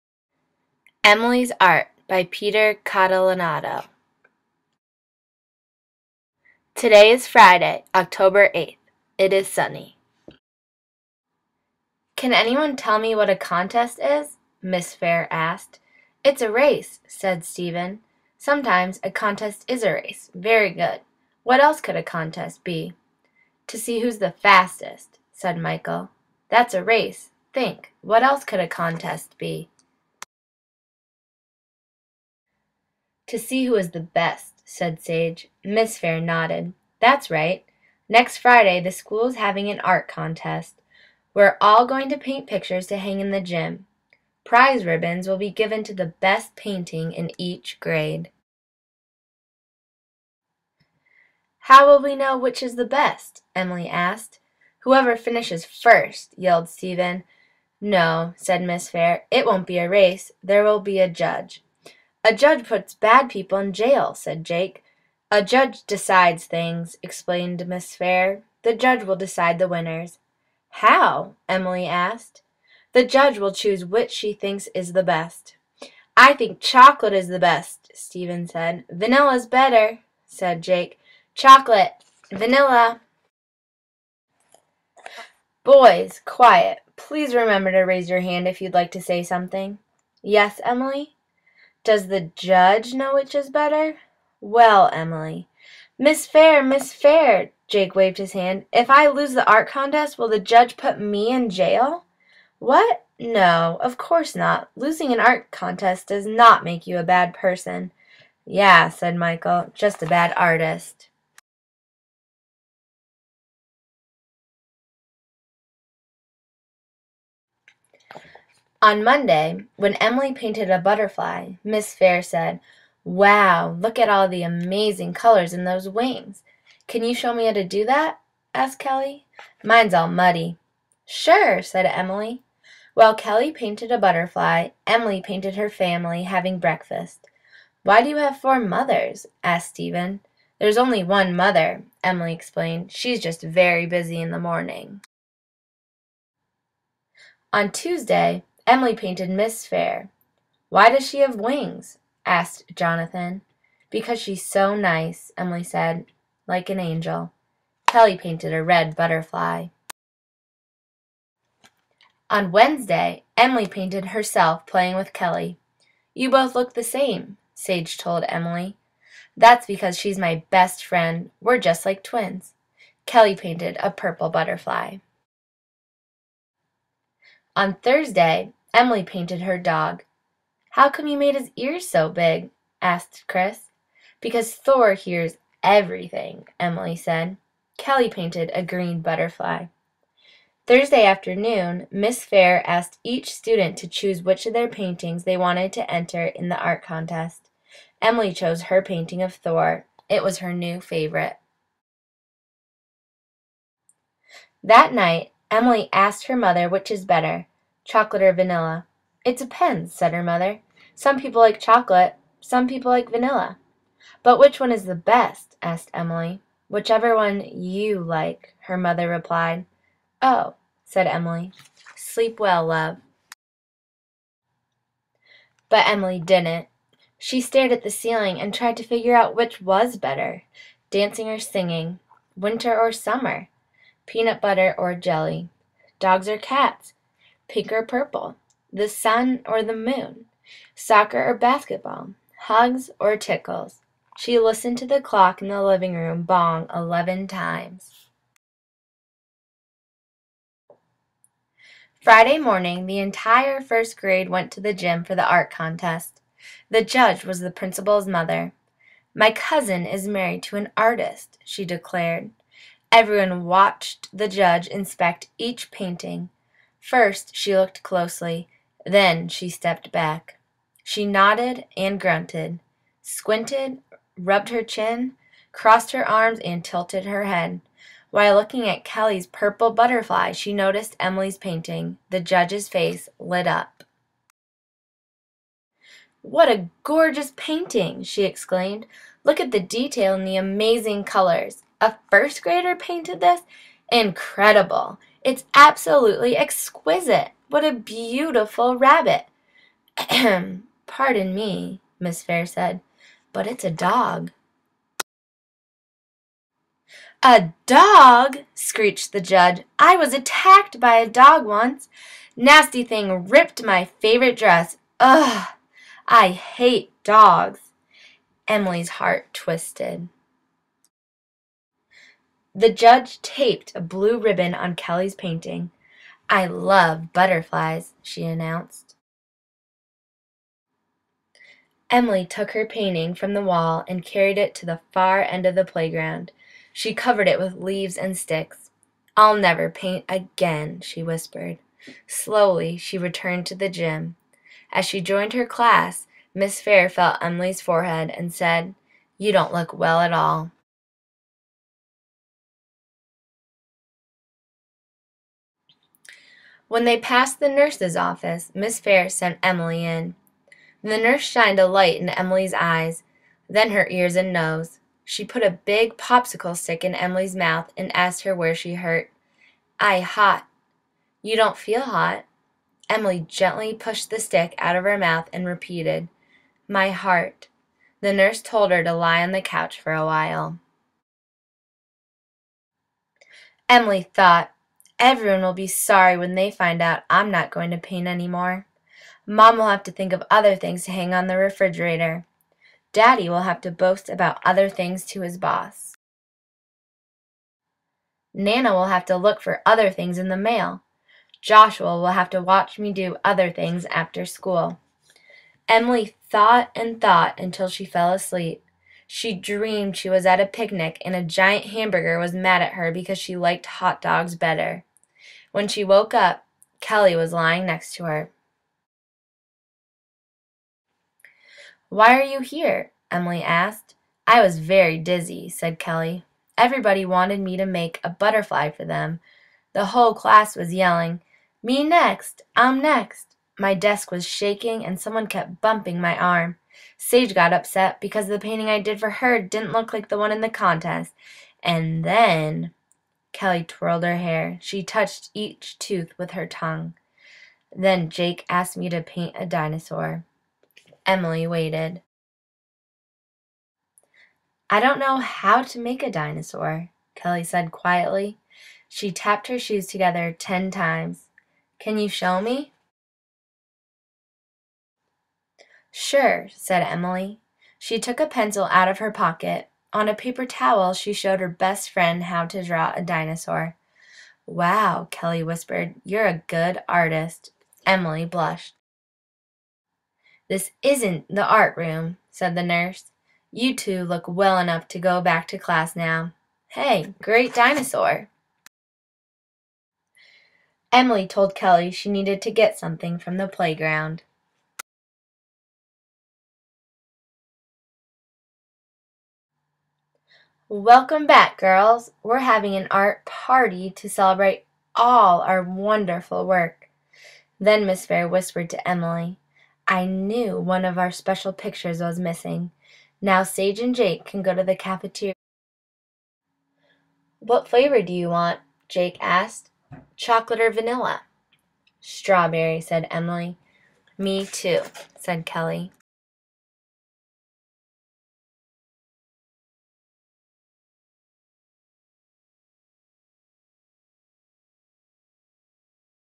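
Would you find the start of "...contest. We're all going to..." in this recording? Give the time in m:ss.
0:40.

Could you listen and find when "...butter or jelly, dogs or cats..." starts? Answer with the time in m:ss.
3:54.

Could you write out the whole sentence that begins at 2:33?
"Because she's so nice," Emily said, "like an angel." Kelly painted a red butterfly.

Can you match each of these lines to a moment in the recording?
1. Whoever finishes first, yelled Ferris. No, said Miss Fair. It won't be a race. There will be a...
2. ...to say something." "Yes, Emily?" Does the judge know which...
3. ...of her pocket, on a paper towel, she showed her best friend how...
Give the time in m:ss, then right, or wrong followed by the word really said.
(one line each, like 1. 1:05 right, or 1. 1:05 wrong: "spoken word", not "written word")
1. 0:54 wrong: "Stephen", not "Ferris"
2. 1:28 right
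3. 7:48 right.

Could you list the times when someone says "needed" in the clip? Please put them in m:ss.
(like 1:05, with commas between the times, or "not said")
8:12.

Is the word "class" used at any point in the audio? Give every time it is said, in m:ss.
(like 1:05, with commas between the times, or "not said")
5:45, 7:10, 8:05.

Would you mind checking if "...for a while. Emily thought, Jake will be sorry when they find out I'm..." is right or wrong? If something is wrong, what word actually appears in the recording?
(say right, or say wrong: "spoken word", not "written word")
wrong: "Everyone", not "Jake".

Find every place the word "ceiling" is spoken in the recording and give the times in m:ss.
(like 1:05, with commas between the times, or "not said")
3:47.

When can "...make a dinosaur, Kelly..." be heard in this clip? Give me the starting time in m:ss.
7:35.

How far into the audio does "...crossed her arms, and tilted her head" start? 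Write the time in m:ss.
4:35.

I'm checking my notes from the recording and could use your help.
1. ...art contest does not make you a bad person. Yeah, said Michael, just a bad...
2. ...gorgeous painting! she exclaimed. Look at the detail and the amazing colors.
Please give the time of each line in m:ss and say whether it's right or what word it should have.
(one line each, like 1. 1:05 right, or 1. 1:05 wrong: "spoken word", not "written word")
1. 1:45 right
2. 4:46 right.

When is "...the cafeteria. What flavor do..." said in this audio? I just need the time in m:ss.
8:34.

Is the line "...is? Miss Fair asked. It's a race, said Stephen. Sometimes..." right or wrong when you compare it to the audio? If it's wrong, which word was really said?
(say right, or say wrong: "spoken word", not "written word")
right.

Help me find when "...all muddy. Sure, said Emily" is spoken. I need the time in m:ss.
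2:09.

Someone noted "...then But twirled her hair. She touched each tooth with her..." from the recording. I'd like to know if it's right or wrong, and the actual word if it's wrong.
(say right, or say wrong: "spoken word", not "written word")
wrong: "Kelly", not "But".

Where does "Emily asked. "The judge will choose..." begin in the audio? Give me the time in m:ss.
1:11.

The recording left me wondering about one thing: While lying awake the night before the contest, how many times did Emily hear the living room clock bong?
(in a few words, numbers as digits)
11.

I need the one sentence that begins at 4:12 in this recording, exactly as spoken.
Friday morning, the entire first grade went to the gym for the art contest.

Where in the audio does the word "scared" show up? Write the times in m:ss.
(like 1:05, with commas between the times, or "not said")
not said.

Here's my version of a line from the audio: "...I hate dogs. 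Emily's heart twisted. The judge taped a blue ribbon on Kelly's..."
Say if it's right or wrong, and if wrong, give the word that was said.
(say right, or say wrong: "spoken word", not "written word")
right.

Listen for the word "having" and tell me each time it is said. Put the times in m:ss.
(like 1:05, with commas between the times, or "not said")
0:39, 2:16, 8:22.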